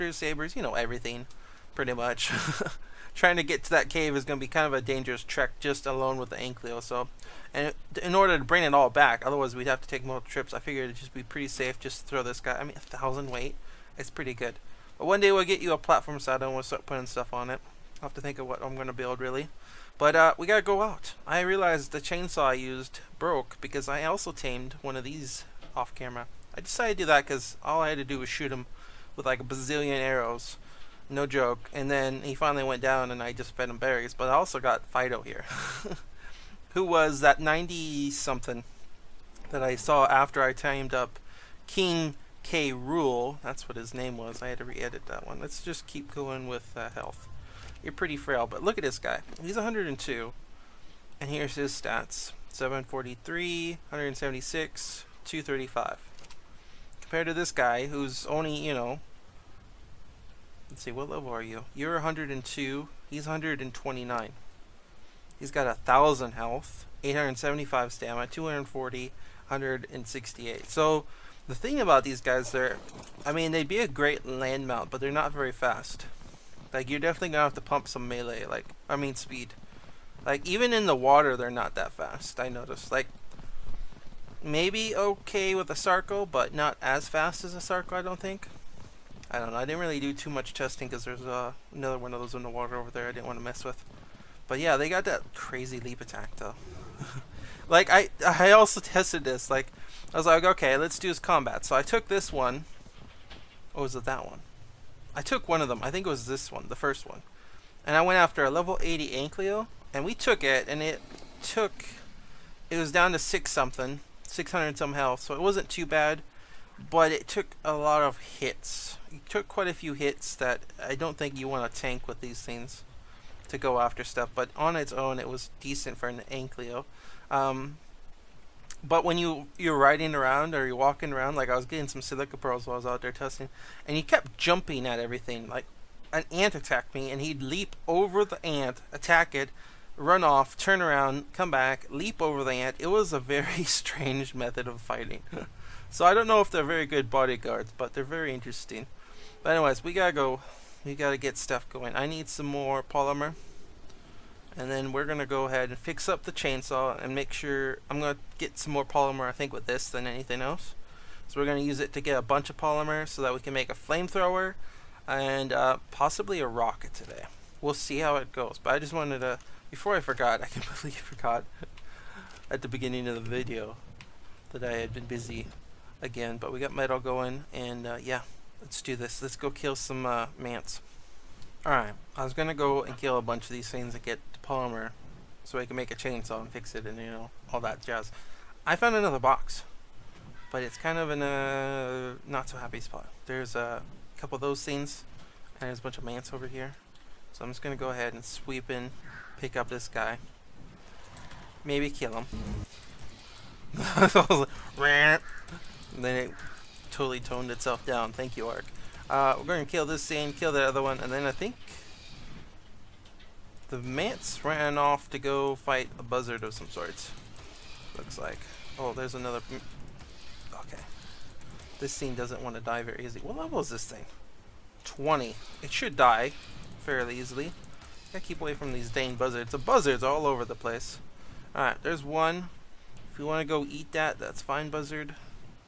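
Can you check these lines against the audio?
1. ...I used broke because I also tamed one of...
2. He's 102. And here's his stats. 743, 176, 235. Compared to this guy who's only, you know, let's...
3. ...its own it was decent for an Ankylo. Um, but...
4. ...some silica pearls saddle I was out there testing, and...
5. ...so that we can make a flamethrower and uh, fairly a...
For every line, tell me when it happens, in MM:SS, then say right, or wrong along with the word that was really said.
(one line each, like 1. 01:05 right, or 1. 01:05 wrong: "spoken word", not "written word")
1. 00:22 right
2. 00:49 right
3. 02:04 right
4. 02:11 wrong: "while", not "saddle"
5. 02:43 wrong: "possibly", not "fairly".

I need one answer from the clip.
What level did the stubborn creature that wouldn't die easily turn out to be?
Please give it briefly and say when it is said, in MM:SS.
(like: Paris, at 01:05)
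20, at 03:44.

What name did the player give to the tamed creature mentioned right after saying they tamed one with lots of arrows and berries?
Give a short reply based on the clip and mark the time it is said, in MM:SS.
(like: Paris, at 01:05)
Fido, at 00:34.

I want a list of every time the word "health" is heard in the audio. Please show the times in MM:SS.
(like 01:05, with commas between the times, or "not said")
00:46, 01:06, 01:54.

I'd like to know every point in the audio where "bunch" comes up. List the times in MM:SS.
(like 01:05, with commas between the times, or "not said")
02:42, 03:03, 03:15.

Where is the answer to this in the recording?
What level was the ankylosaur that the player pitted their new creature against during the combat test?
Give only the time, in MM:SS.
01:48.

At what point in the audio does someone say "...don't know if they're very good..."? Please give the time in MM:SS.
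02:26.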